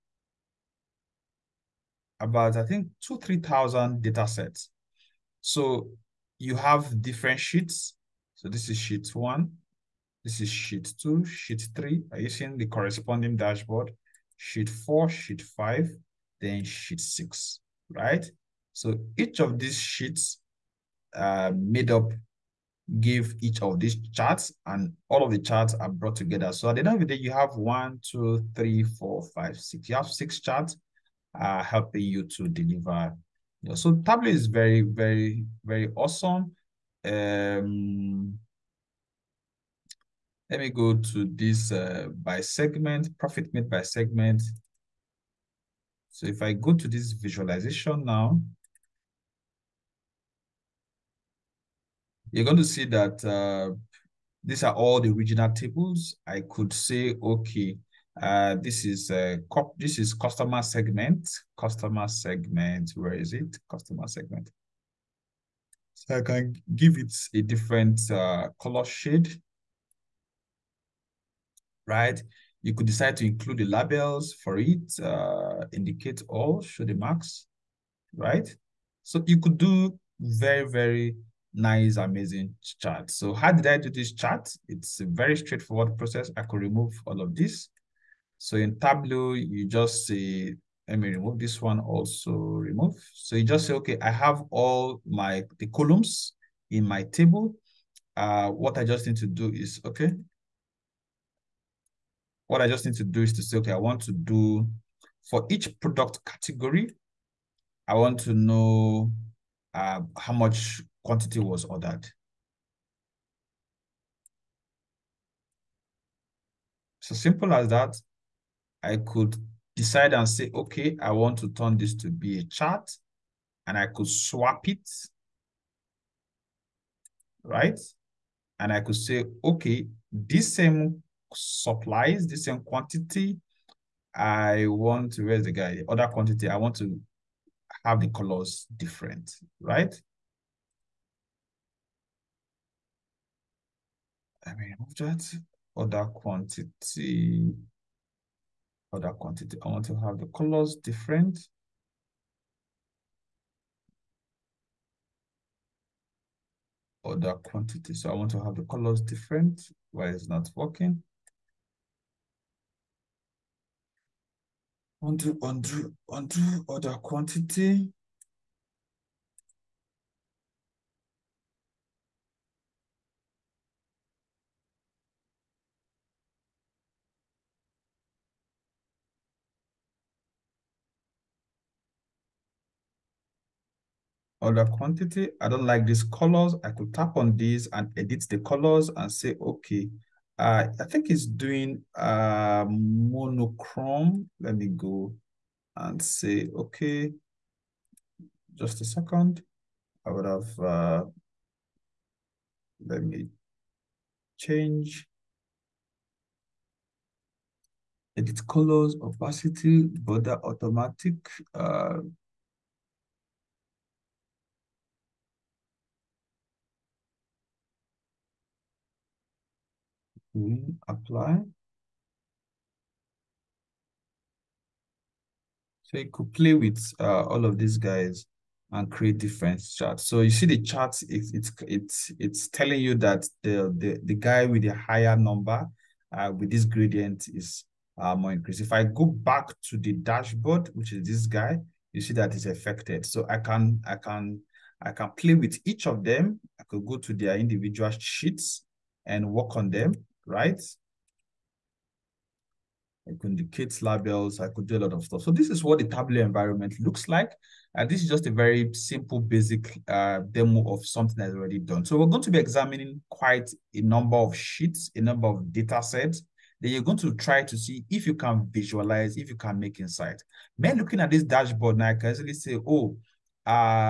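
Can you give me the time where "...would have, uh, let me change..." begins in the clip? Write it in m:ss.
3:20.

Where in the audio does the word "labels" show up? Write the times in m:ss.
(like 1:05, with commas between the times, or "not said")
1:13, 4:13.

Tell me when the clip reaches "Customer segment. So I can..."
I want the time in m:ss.
1:03.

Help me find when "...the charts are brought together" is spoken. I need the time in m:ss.
0:25.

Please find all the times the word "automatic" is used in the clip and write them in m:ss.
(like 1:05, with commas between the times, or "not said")
3:30.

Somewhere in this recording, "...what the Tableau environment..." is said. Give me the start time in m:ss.
4:15.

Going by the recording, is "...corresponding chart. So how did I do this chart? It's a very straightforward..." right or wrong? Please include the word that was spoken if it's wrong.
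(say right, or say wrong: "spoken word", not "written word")
wrong: "amazing", not "corresponding".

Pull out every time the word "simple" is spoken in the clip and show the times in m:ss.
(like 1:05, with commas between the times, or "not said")
1:57, 4:18.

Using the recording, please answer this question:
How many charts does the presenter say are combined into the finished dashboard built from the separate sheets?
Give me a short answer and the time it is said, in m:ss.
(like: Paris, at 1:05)
6, at 0:29.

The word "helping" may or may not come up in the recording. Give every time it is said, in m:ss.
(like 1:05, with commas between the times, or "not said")
0:31.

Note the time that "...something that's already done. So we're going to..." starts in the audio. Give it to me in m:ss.
4:20.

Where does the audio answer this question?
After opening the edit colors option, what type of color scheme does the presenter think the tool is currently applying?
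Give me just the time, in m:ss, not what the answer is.
3:12.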